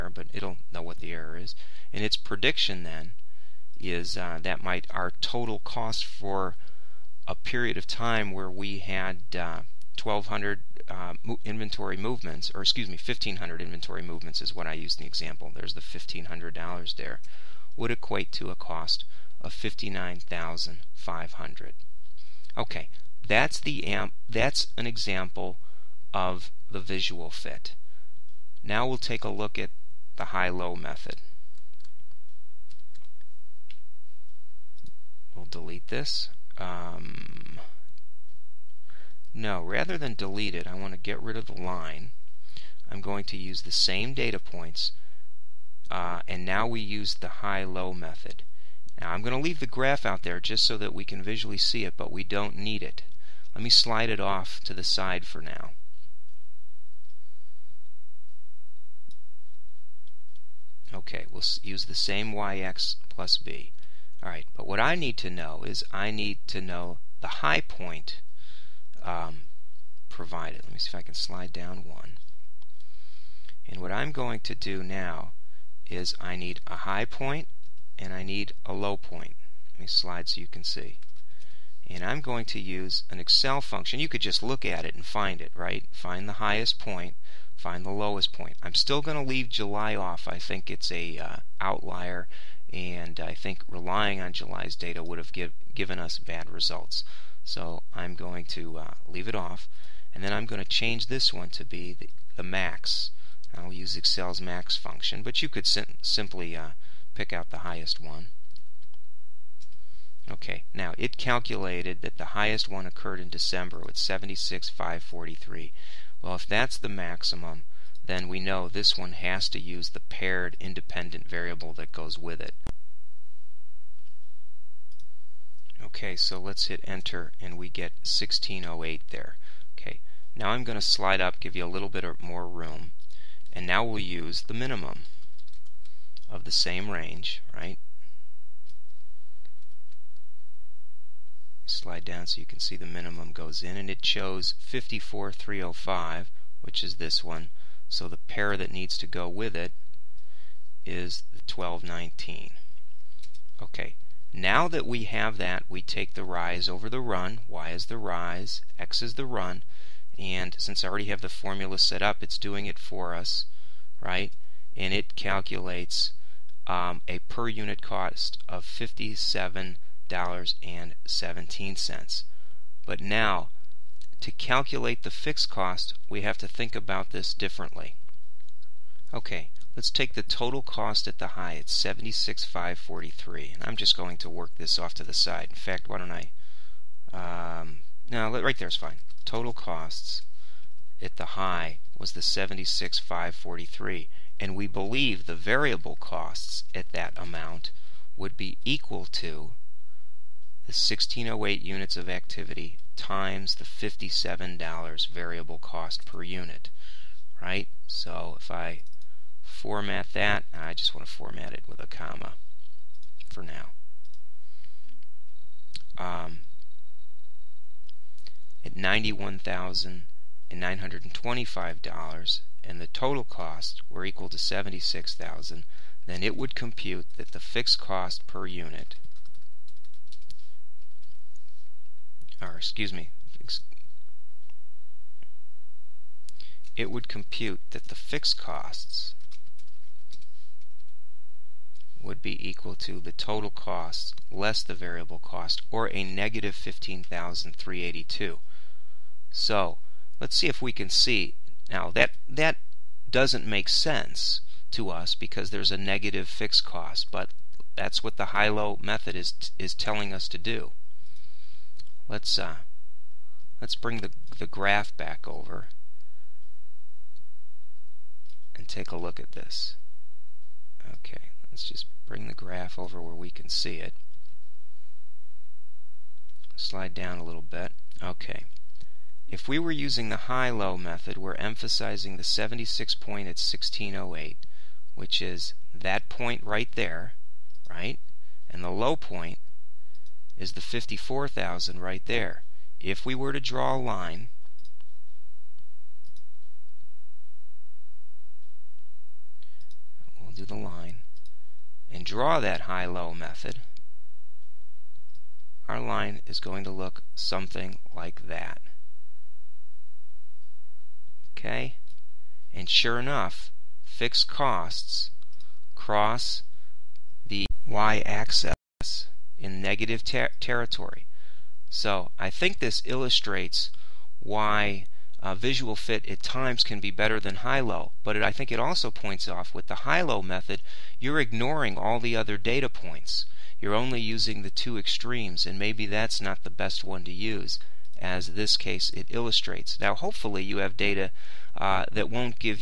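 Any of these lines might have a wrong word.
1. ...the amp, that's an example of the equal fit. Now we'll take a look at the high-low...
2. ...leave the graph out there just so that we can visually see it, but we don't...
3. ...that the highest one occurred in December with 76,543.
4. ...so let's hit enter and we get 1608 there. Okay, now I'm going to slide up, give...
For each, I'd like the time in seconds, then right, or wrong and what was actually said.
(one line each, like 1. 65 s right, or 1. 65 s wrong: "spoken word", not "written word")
1. 23 s wrong: "visual", not "equal"
2. 49 s right
3. 112 s right
4. 126 s right.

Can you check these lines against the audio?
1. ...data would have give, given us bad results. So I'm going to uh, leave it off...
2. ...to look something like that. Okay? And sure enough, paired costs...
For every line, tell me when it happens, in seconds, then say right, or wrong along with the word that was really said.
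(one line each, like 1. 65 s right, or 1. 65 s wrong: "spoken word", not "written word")
1. 94 s right
2. 306 s wrong: "fixed", not "paired".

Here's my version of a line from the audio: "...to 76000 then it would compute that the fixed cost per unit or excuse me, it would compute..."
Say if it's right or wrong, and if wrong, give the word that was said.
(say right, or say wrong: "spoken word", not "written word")
right.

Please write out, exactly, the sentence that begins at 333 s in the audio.
You're only using the two extremes, and maybe that's not the best one to use, as this case it illustrates.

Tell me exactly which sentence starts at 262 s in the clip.
Let's uh, let's bring the the graph back over and take a look at this.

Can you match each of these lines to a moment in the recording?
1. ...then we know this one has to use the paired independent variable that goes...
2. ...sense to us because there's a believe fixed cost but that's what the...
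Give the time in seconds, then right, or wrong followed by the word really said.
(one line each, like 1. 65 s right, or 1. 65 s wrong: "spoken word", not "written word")
1. 118 s right
2. 253 s wrong: "negative", not "believe".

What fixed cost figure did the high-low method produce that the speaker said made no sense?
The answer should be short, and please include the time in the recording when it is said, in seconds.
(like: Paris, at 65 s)
-15,382, at 246 s.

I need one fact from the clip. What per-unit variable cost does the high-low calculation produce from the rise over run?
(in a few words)
$57.17.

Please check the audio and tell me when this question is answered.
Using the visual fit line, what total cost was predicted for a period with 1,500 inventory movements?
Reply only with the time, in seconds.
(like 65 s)
19 s.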